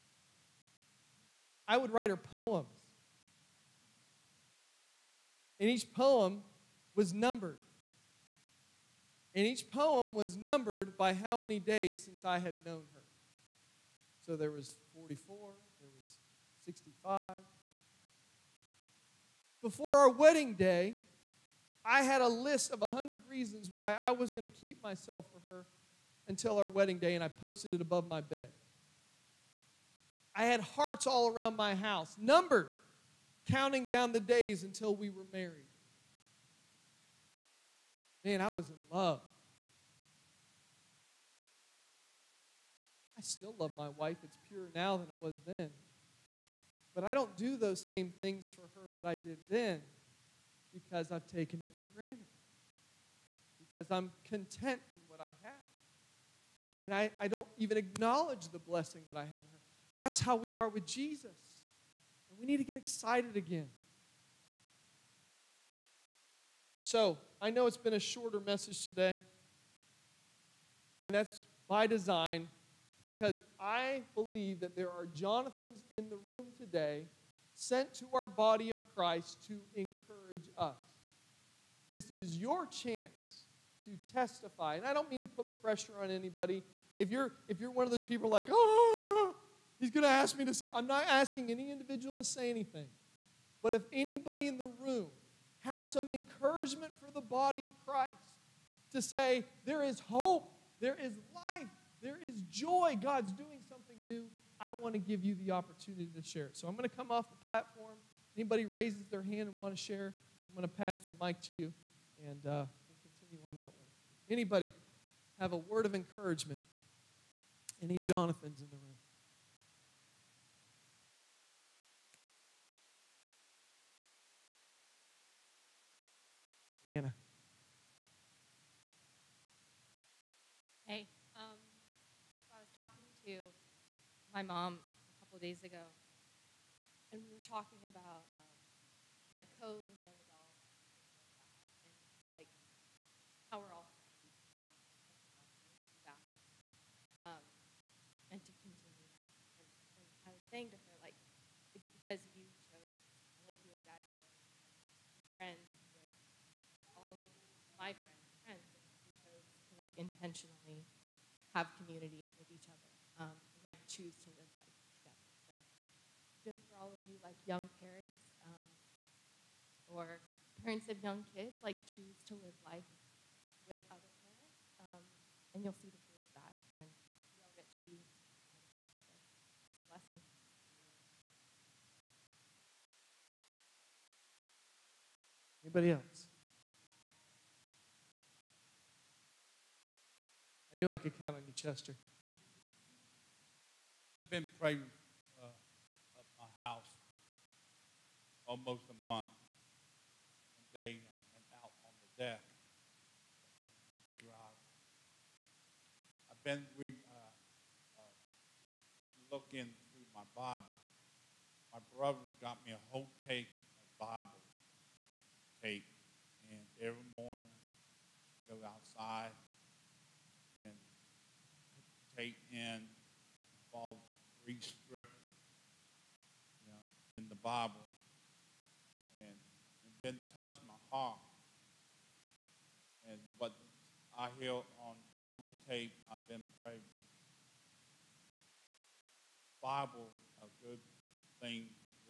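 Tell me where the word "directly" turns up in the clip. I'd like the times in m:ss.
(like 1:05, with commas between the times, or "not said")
not said.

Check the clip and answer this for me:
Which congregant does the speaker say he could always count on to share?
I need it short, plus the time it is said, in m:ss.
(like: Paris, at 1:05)
Chester, at 3:11.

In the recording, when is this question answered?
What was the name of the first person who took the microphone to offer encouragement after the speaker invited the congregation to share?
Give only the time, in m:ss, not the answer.
2:06.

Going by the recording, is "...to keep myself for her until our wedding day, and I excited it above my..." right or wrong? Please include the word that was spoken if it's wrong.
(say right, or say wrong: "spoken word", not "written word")
wrong: "posted", not "excited".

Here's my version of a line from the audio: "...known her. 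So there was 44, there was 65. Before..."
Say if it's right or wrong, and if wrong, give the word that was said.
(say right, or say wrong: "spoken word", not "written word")
right.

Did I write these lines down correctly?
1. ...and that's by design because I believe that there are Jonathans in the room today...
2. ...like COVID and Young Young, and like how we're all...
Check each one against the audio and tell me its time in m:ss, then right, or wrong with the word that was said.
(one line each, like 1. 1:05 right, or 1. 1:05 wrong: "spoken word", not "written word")
1. 1:11 right
2. 2:19 wrong: "Adult", not "Young".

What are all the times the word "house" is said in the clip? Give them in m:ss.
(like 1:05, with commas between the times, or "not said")
0:31, 3:16.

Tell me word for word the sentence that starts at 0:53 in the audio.
Because I'm content in what I have.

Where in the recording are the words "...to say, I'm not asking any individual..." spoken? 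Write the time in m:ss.
1:30.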